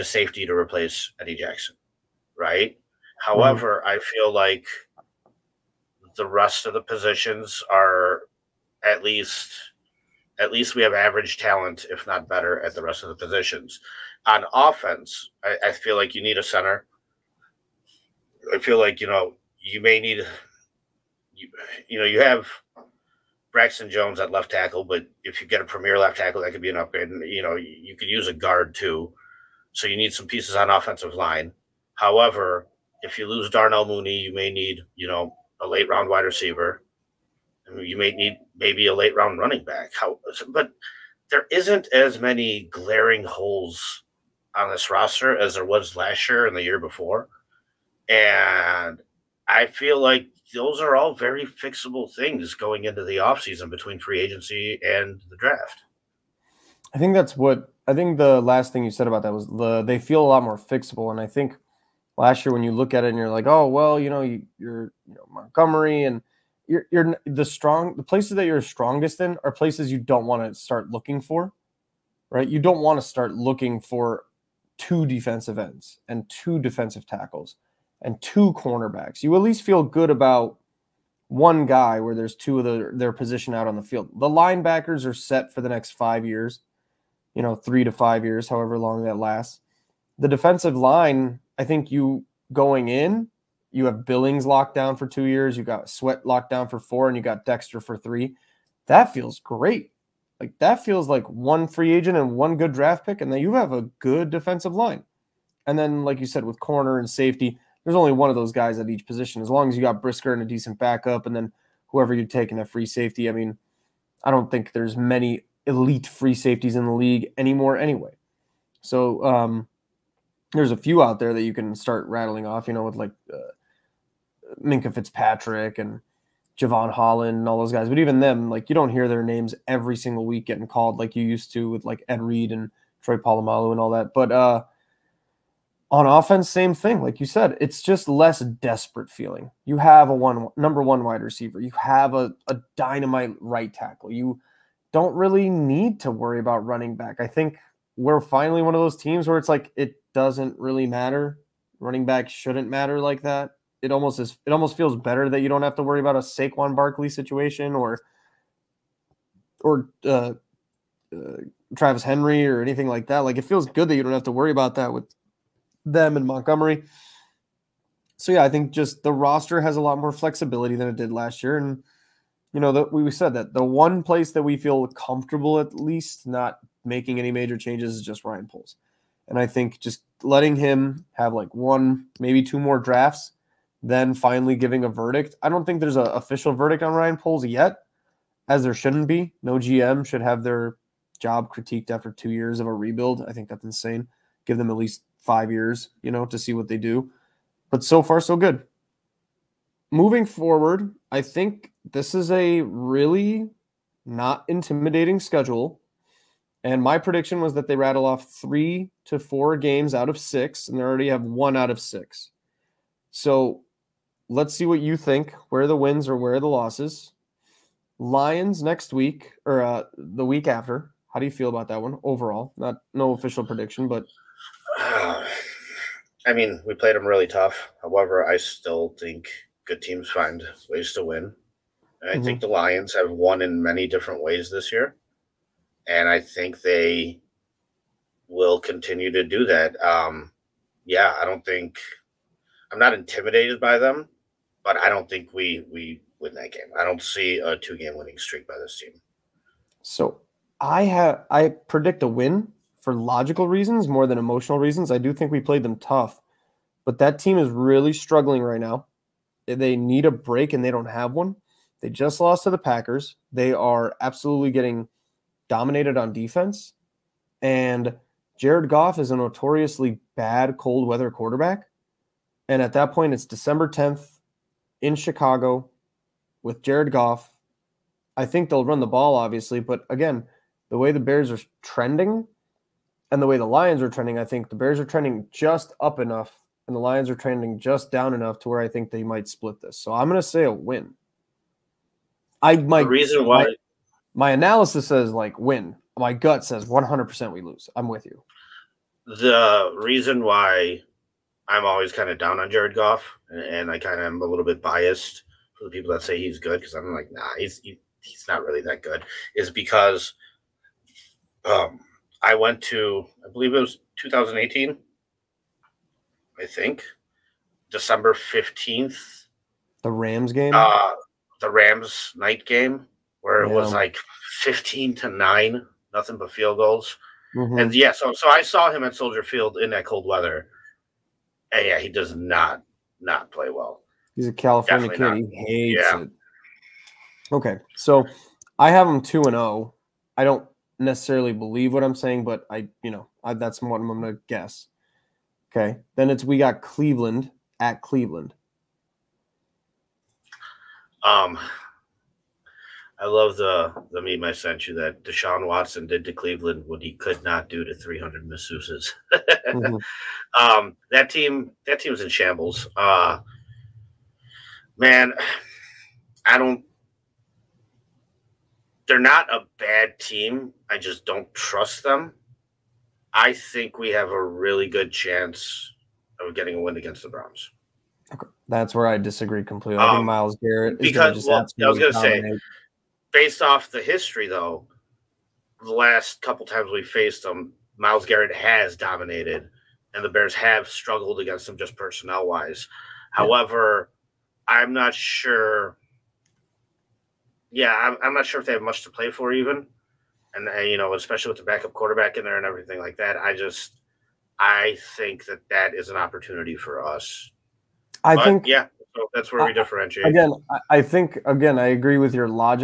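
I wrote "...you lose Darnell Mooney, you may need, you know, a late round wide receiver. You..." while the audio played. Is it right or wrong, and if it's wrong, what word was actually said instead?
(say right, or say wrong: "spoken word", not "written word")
right.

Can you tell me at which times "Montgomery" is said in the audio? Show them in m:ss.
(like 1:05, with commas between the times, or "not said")
1:05, 2:46.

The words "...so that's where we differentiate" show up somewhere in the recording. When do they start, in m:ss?
6:48.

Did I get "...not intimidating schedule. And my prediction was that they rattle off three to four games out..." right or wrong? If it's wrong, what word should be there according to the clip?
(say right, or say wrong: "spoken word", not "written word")
right.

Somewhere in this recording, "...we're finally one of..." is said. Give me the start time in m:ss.
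2:27.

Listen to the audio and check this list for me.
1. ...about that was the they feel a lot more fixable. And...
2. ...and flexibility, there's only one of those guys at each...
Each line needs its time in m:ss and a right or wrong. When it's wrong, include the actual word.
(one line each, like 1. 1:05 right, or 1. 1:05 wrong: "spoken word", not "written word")
1. 0:59 right
2. 1:46 wrong: "safety", not "flexibility".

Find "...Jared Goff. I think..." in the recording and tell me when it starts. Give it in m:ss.
4:36.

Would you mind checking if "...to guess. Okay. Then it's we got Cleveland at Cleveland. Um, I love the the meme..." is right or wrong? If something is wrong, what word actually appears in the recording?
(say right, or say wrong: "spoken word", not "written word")
right.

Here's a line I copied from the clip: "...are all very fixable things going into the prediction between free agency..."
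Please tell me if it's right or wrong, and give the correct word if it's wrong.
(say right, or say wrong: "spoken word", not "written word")
wrong: "offseason", not "prediction".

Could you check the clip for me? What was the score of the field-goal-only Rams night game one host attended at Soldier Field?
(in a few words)
15 to 9.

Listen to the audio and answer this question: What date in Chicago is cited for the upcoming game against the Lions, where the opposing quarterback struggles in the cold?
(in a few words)
December 10th.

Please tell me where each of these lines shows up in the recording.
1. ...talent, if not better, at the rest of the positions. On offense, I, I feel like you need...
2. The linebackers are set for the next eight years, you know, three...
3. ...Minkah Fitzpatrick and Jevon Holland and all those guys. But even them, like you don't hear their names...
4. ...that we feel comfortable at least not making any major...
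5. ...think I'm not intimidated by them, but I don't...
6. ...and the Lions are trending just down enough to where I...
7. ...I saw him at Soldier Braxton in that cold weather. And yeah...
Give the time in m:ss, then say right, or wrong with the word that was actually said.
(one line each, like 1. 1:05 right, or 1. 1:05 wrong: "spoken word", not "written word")
1. 0:11 right
2. 1:24 wrong: "five", not "eight"
3. 2:04 right
4. 2:54 right
5. 4:01 right
6. 4:46 right
7. 5:28 wrong: "Field", not "Braxton".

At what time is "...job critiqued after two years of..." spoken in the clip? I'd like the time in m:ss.
3:11.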